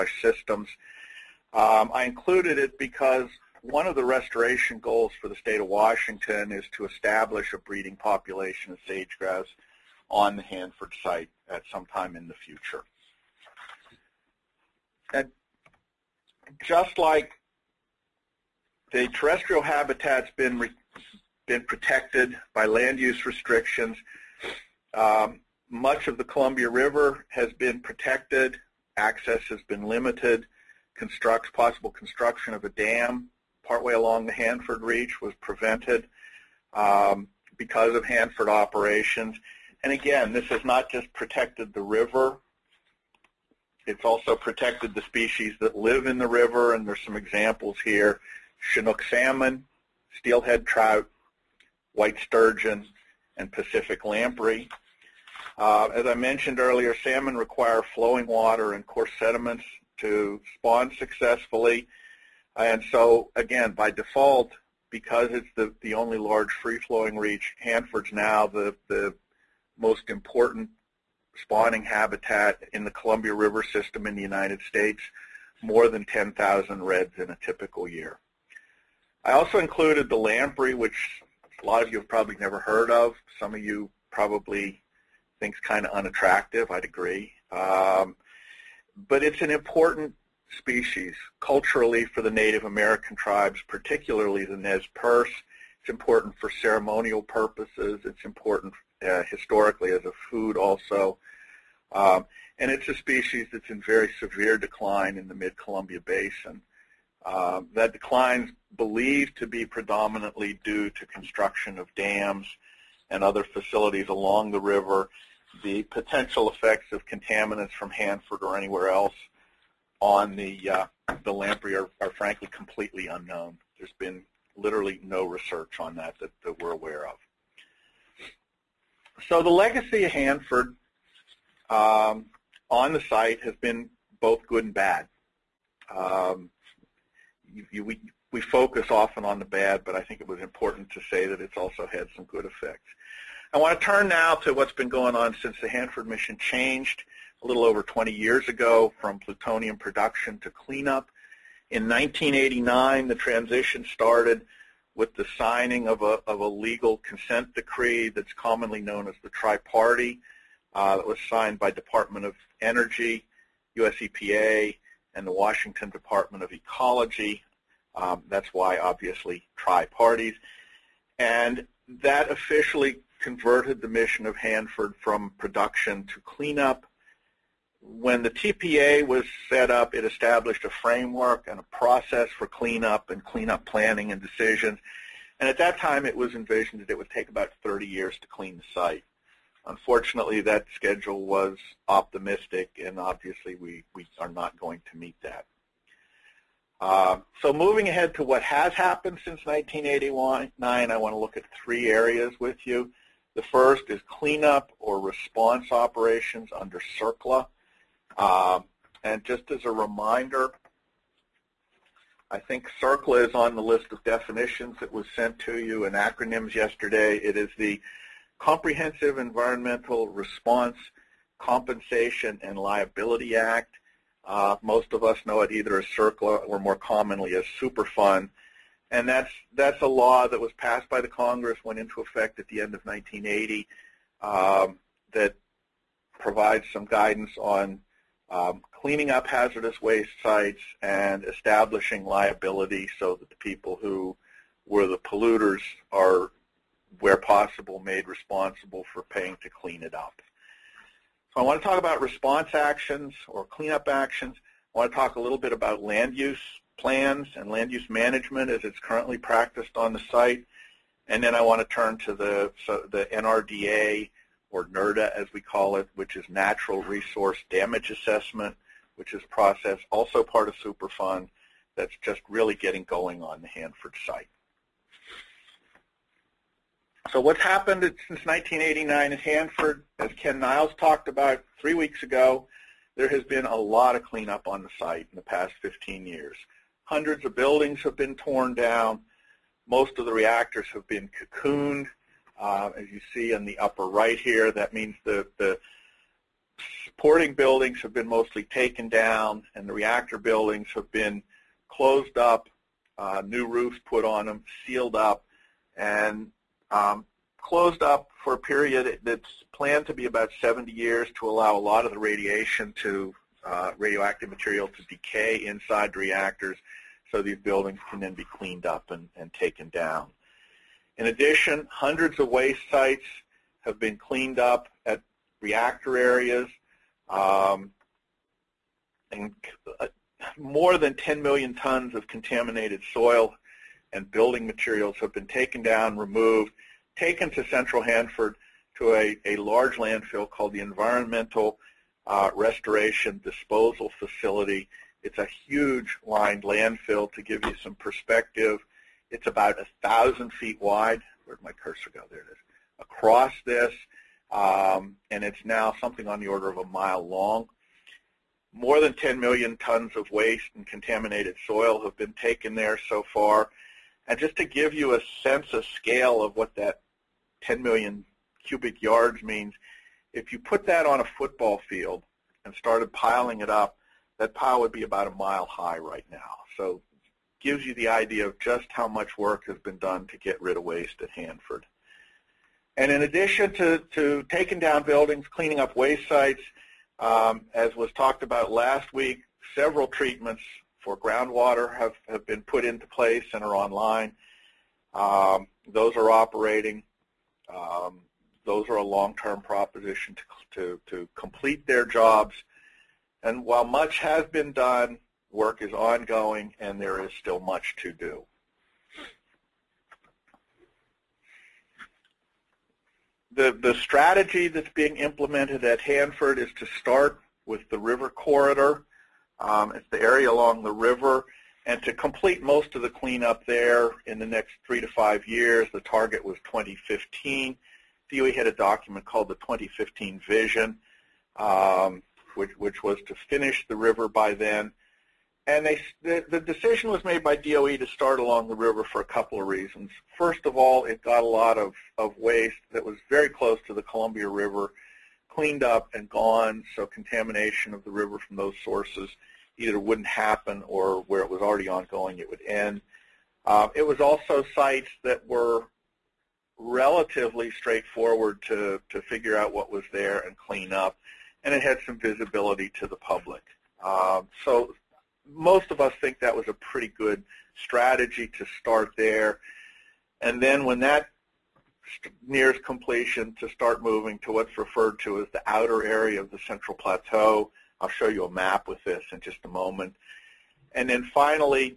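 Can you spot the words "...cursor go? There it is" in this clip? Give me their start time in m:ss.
5:51.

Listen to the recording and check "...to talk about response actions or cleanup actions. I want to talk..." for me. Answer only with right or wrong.
right.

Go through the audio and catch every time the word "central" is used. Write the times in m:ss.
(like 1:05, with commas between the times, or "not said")
5:37, 7:56.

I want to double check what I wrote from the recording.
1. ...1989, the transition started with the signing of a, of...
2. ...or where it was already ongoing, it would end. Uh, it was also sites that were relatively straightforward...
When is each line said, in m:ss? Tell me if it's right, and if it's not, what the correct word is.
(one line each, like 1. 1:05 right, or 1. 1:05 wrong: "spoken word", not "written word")
1. 2:31 right
2. 7:30 right.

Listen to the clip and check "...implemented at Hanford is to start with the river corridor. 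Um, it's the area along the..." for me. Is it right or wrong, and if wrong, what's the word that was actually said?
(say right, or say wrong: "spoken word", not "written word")
right.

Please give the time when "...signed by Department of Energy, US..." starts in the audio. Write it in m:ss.
2:41.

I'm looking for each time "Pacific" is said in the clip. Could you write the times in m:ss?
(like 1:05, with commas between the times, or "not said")
0:53.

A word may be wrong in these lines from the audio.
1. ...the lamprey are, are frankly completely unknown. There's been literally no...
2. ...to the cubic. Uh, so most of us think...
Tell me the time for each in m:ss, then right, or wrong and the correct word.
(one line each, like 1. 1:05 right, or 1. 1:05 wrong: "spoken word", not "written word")
1. 2:01 right
2. 7:42 wrong: "public", not "cubic".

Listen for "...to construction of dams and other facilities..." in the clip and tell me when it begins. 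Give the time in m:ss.
1:50.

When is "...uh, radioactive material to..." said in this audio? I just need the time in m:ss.
5:13.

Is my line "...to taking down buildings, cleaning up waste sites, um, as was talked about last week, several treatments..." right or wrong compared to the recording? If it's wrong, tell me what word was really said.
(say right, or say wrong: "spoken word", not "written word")
right.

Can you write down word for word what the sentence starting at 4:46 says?
Hundreds of buildings have been torn down.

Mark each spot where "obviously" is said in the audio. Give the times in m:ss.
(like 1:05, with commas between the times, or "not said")
2:48, 3:12.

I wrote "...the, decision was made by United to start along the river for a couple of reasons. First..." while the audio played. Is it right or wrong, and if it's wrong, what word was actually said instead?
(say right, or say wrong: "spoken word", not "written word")
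wrong: "DOE", not "United".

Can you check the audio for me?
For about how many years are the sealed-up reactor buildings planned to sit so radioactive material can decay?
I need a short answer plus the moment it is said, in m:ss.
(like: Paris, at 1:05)
70 years, at 5:10.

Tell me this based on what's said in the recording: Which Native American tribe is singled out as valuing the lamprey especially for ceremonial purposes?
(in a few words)
Nez Perce.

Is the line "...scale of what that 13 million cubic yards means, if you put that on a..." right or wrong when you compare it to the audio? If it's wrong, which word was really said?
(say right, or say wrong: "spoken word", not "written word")
wrong: "10", not "13".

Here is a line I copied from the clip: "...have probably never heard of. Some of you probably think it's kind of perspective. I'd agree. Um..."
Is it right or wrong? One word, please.
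wrong.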